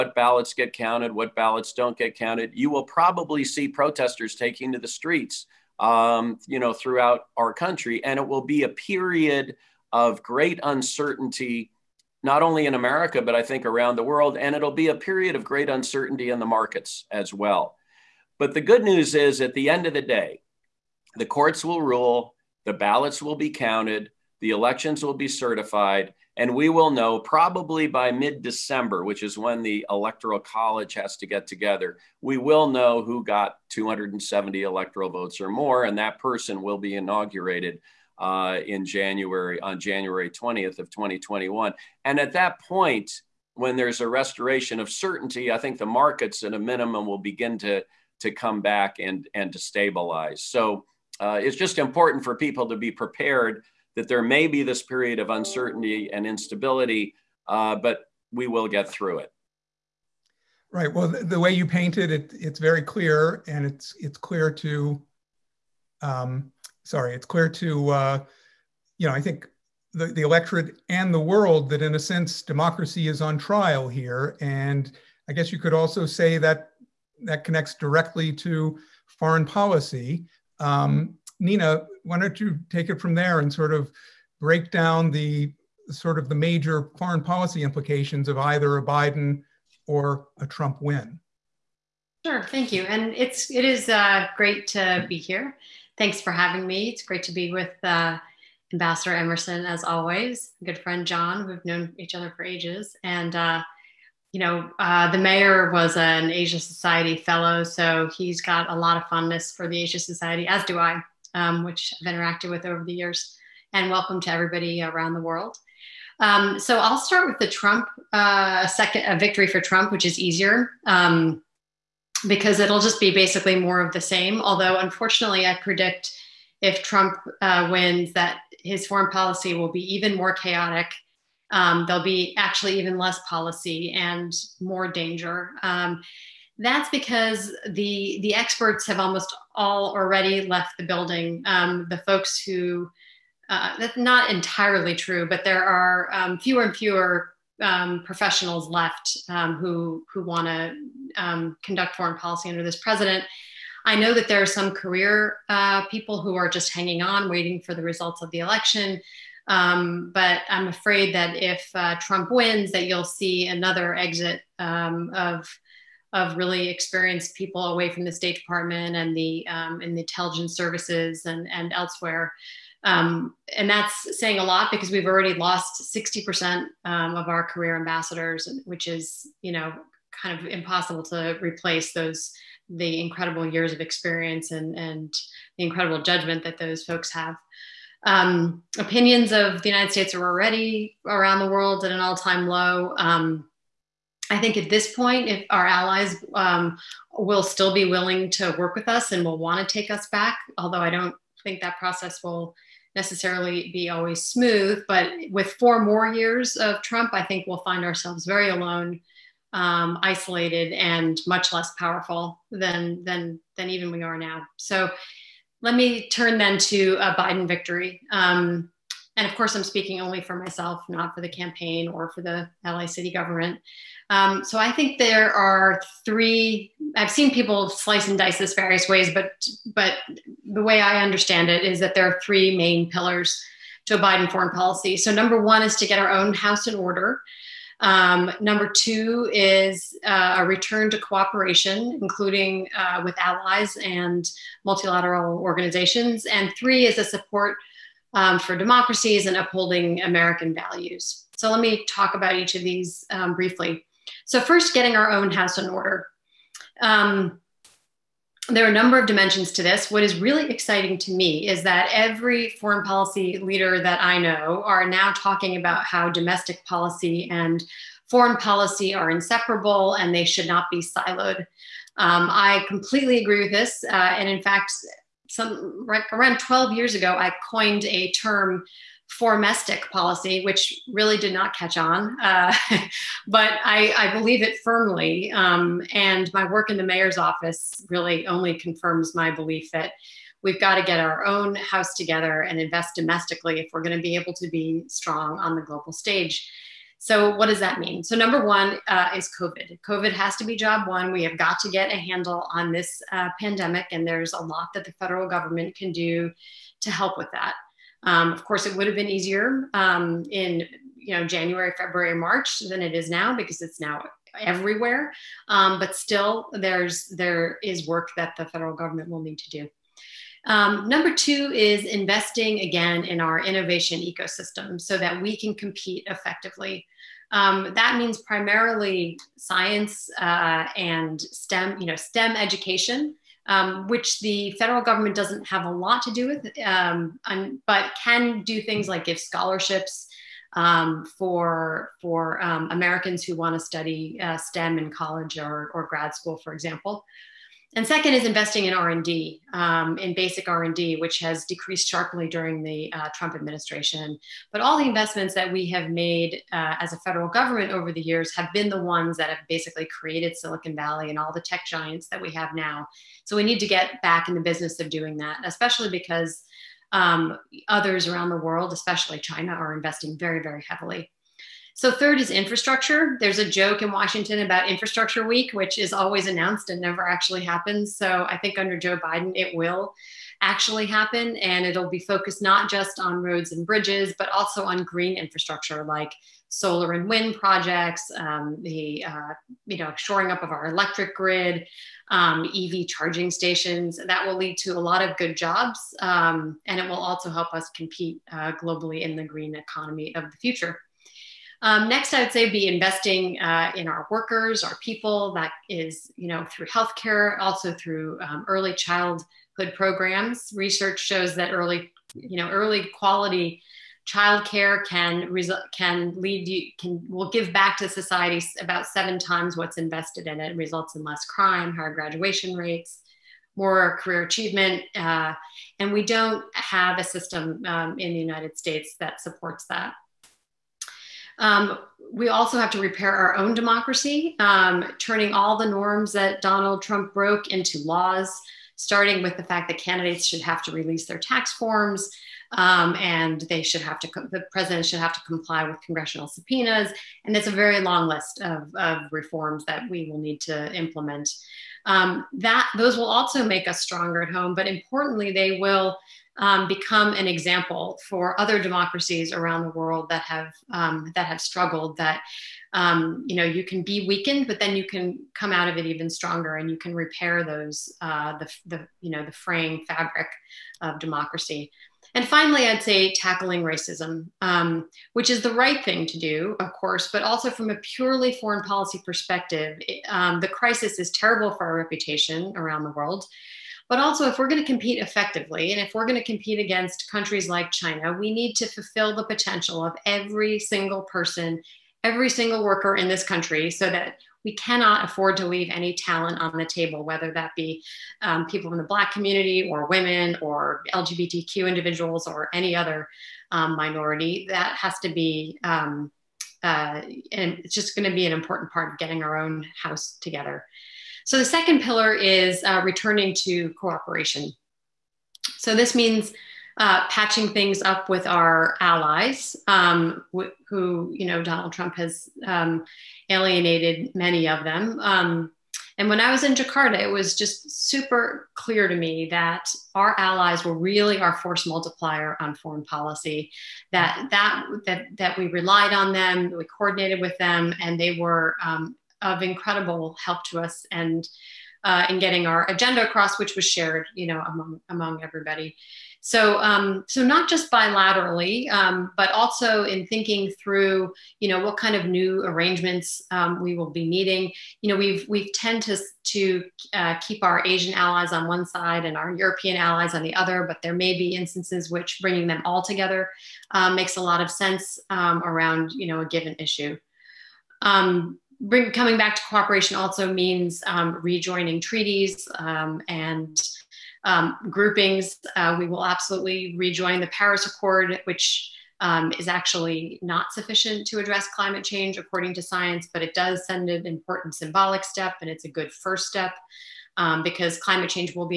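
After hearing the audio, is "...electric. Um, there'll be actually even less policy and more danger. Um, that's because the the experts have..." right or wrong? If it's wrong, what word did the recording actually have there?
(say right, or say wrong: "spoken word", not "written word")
wrong: "chaotic", not "electric".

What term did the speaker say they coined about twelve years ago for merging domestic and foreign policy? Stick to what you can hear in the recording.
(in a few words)
formestic policy.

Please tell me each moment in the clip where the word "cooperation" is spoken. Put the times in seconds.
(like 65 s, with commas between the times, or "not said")
240 s, 513 s, 569 s.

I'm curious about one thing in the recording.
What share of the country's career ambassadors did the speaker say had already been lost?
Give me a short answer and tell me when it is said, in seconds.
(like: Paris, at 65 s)
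60%, at 175 s.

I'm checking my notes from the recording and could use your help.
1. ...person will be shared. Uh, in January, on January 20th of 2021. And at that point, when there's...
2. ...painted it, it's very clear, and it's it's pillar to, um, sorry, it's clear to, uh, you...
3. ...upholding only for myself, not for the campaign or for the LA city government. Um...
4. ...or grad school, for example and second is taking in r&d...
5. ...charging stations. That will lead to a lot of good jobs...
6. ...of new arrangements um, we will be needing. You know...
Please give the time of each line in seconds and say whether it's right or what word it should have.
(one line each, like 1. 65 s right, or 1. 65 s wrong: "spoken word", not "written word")
1. 36 s wrong: "inaugurated", not "shared"
2. 61 s wrong: "clear", not "pillar"
3. 219 s wrong: "speaking", not "upholding"
4. 345 s wrong: "investing", not "taking"
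5. 392 s right
6. 551 s right.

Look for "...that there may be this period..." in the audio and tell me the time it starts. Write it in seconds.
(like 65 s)
53 s.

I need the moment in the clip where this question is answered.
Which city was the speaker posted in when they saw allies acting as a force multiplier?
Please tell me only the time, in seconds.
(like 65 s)
526 s.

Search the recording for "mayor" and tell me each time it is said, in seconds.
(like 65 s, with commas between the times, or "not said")
105 s, 286 s.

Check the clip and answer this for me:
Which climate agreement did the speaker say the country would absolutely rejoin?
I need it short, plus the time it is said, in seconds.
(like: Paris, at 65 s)
Paris Accord, at 577 s.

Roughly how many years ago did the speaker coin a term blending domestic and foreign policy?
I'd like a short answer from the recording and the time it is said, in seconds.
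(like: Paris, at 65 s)
12, at 276 s.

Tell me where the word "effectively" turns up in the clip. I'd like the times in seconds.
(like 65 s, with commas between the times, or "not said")
326 s, 485 s.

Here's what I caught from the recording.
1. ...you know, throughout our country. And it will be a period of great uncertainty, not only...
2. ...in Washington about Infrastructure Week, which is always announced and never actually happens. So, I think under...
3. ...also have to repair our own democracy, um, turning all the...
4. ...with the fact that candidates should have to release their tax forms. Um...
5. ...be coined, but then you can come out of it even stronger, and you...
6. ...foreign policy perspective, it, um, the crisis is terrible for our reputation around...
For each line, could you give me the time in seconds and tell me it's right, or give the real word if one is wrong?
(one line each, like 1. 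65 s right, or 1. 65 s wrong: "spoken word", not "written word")
1. 6 s right
2. 373 s right
3. 432 s right
4. 439 s right
5. 463 s wrong: "weakened", not "coined"
6. 478 s right.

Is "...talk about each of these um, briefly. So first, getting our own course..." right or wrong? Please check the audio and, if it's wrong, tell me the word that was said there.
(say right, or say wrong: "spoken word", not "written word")
wrong: "house", not "course".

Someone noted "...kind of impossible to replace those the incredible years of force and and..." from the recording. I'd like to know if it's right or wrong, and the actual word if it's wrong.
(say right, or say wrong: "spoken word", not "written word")
wrong: "experience", not "force".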